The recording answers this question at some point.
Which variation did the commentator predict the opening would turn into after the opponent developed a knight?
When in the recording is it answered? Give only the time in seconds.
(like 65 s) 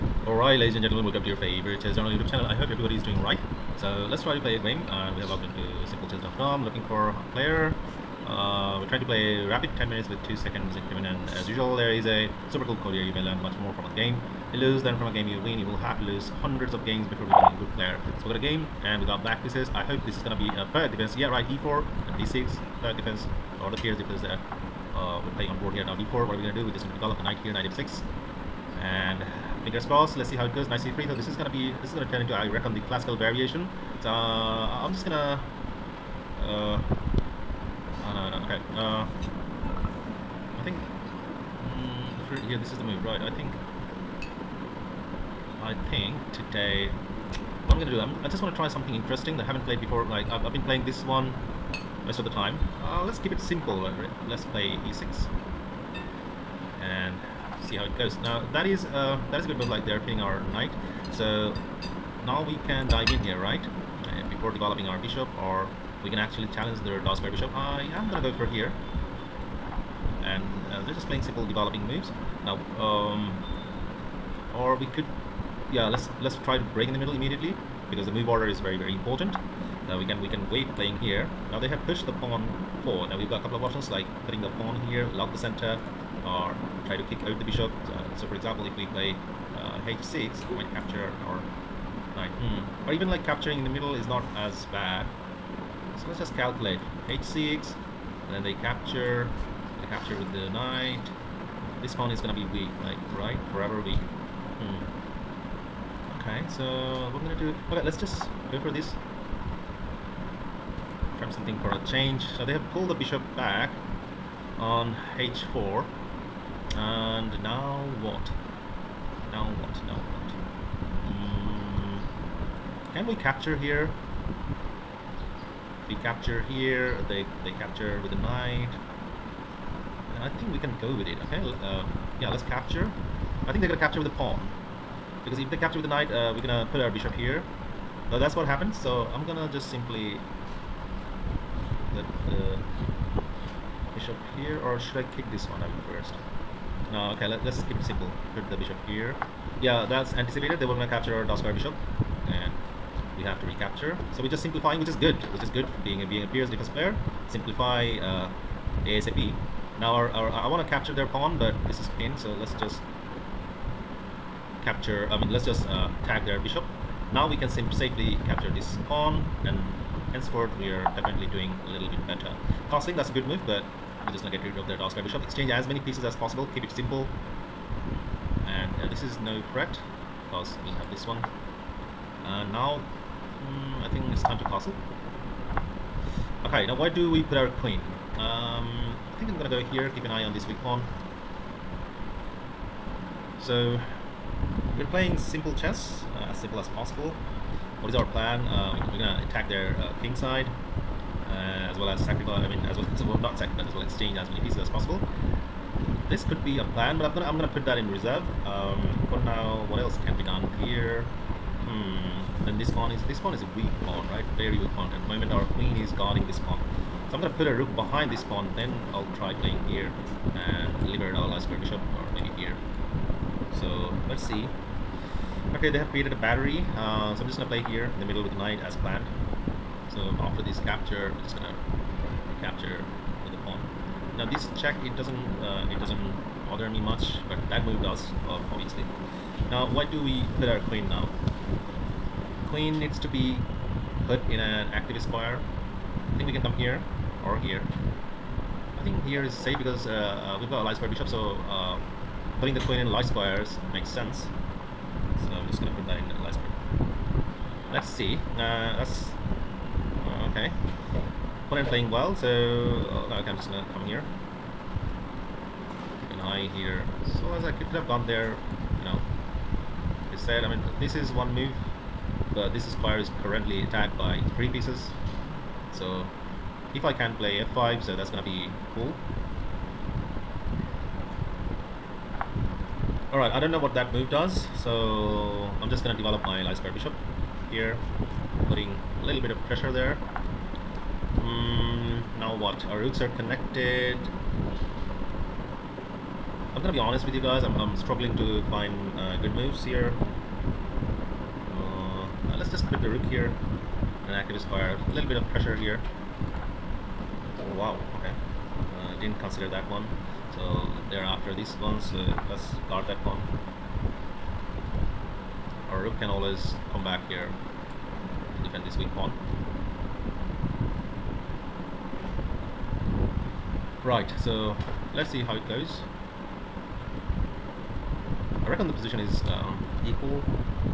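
32 s.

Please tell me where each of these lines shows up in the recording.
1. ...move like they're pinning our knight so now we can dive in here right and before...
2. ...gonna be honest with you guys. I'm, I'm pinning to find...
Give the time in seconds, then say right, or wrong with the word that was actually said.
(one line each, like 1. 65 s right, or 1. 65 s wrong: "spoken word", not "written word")
1. 59 s right
2. 296 s wrong: "struggling", not "pinning".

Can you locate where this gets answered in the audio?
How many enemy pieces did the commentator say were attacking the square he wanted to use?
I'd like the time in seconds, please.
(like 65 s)
274 s.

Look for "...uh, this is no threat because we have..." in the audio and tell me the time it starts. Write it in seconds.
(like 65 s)
178 s.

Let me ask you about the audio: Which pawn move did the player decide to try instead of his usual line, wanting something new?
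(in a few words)
e6.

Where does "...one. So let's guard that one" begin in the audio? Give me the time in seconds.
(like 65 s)
311 s.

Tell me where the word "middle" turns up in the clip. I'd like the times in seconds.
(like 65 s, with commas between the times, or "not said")
76 s, 93 s, 228 s.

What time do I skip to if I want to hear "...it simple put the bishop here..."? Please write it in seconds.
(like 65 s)
147 s.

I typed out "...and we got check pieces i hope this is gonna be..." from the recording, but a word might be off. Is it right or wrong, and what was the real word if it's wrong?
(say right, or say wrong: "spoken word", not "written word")
wrong: "black", not "check".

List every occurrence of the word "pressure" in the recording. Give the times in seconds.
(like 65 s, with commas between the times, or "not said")
289 s, 305 s.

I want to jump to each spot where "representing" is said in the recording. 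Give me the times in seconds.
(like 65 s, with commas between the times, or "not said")
not said.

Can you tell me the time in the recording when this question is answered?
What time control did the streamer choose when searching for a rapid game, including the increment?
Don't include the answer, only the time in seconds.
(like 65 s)
9 s.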